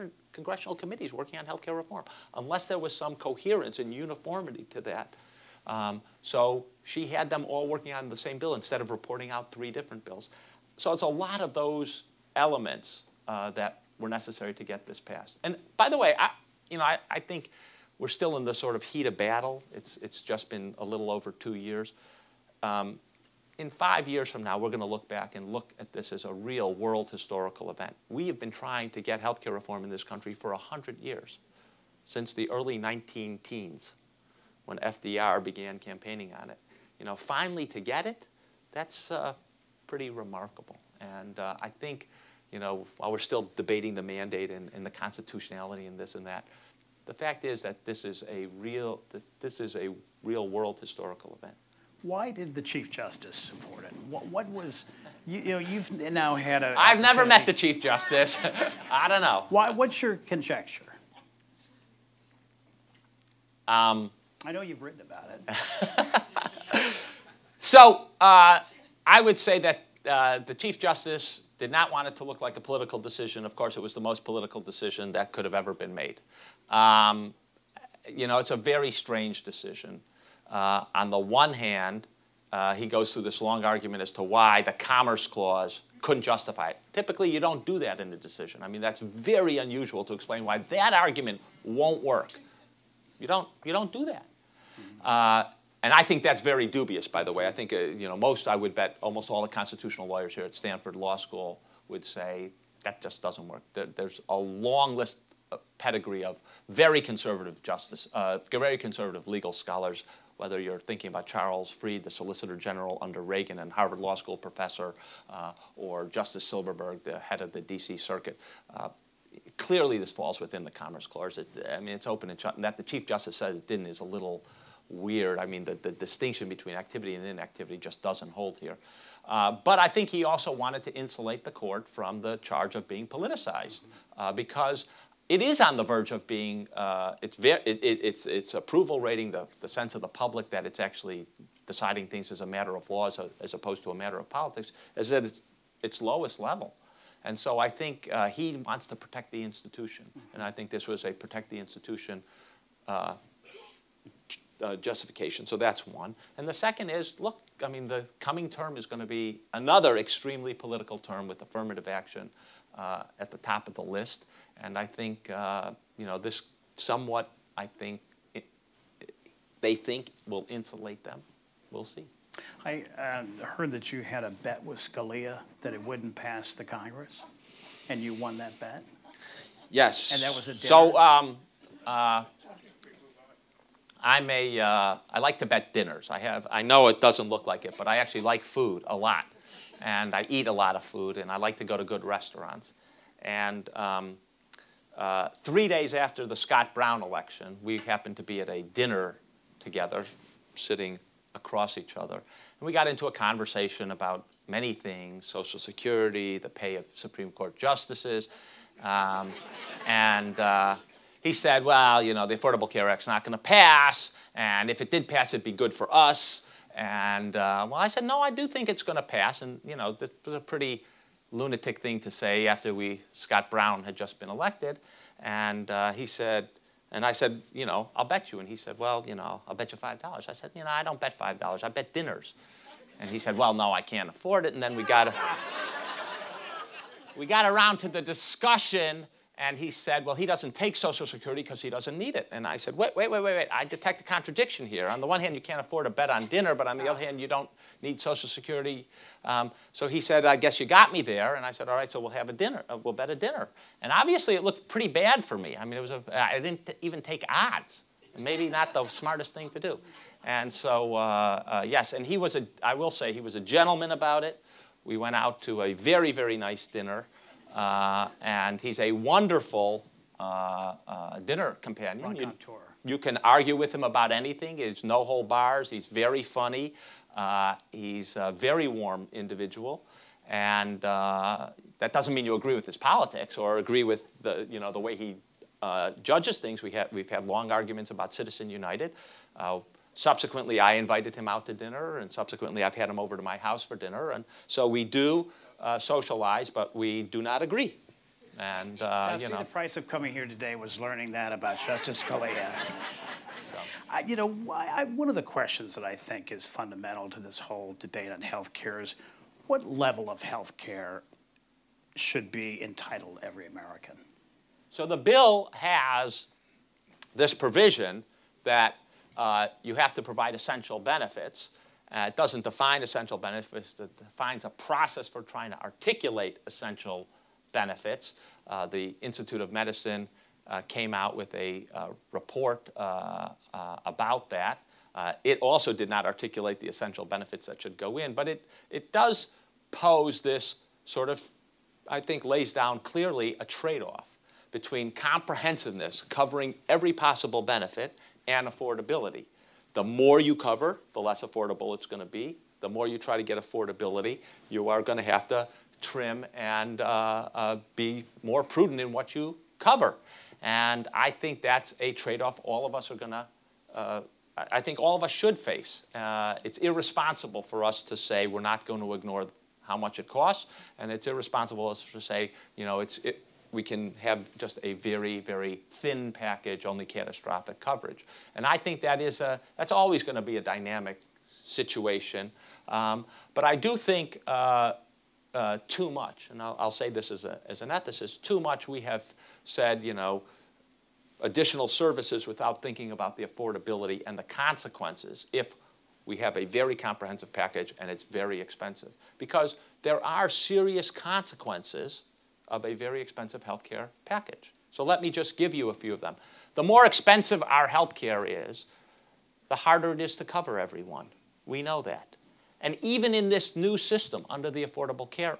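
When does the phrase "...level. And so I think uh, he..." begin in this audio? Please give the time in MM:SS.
02:26.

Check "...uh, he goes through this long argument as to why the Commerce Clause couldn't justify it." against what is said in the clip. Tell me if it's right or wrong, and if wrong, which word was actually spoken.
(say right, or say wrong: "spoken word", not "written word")
right.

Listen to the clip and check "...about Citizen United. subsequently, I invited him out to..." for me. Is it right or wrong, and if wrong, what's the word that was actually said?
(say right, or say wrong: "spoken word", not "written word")
right.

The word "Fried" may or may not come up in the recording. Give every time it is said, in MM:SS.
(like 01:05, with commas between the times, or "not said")
01:51.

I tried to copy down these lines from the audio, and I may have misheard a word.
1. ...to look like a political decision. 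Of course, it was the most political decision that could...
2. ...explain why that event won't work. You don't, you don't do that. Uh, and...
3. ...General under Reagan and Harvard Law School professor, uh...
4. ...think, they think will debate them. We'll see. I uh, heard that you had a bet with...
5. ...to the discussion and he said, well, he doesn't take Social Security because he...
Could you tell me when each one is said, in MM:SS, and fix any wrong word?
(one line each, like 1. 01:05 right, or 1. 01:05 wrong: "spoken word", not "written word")
1. 01:12 right
2. 01:30 wrong: "argument", not "event"
3. 01:52 right
4. 02:47 wrong: "insulate", not "debate"
5. 03:57 right.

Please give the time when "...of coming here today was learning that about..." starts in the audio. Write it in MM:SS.
04:59.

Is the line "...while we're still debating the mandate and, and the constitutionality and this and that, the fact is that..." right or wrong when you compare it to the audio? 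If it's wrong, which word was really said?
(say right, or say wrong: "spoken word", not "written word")
right.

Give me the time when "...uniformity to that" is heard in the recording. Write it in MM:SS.
00:03.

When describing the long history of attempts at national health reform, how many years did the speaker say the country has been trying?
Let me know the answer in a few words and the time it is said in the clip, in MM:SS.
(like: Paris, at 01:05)
100 years, at 00:30.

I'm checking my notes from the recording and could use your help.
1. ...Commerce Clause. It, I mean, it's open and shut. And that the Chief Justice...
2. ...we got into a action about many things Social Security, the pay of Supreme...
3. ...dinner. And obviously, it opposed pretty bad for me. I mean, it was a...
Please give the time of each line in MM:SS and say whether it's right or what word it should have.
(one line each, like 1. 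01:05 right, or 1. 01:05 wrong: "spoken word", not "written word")
1. 02:00 right
2. 03:22 wrong: "conversation", not "action"
3. 04:13 wrong: "looked", not "opposed".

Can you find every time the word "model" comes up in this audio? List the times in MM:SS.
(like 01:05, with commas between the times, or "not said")
not said.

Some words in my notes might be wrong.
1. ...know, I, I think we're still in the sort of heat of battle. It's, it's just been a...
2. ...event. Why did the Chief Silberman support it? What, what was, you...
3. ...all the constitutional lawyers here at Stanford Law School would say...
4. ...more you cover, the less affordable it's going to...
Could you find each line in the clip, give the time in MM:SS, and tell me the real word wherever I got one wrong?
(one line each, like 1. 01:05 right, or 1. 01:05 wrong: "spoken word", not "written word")
1. 00:16 right
2. 00:51 wrong: "Justice", not "Silberman"
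3. 01:39 right
4. 05:49 right.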